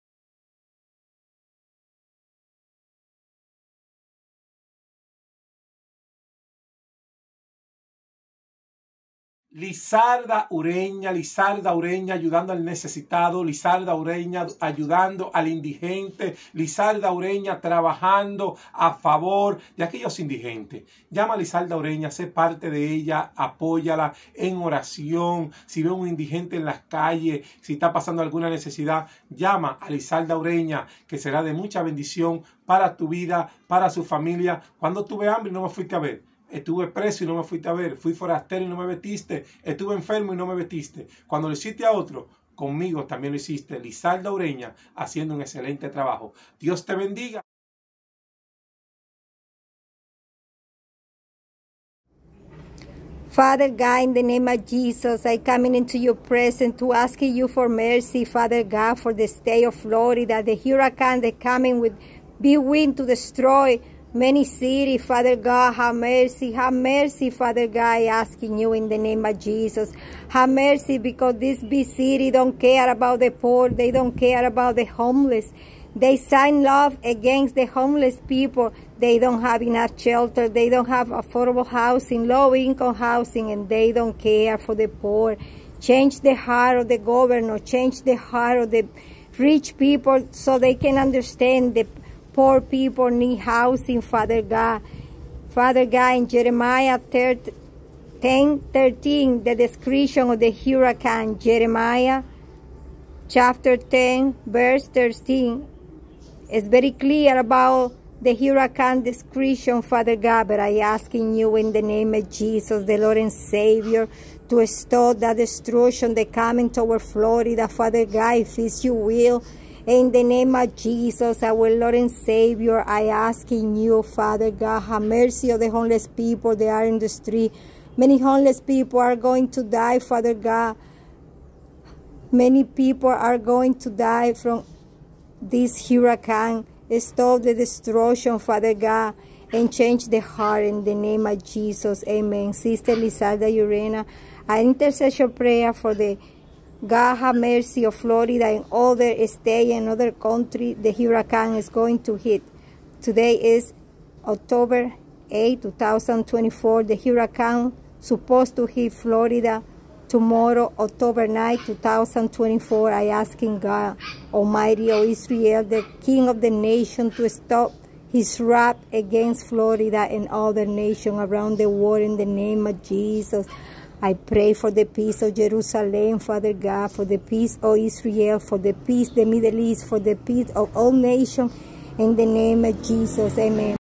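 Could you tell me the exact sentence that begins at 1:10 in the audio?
Have mercy because this big city don't care about the poor, they don't care about the homeless.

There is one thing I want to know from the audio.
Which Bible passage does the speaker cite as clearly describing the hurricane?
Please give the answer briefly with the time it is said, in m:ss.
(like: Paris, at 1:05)
Jeremiah chapter 10, verse 13, at 1:41.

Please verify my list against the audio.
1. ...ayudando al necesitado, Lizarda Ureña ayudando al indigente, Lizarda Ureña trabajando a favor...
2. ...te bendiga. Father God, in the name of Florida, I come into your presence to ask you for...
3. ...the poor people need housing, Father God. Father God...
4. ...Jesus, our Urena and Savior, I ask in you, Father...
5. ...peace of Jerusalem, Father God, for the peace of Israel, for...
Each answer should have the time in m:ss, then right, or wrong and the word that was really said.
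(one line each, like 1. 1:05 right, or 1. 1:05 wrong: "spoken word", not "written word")
1. 0:12 right
2. 0:46 wrong: "Jesus", not "Florida"
3. 1:31 right
4. 2:00 wrong: "Lord", not "Urena"
5. 2:54 right.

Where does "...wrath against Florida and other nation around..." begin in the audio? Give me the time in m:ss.
2:48.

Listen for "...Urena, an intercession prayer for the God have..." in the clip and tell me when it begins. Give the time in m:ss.
2:23.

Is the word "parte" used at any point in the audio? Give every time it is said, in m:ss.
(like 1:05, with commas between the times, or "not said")
0:22.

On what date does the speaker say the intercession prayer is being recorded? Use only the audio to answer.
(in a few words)
October 8, 2024.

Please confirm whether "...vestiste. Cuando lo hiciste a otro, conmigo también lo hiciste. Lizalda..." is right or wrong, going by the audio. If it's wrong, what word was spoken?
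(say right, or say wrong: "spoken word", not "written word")
right.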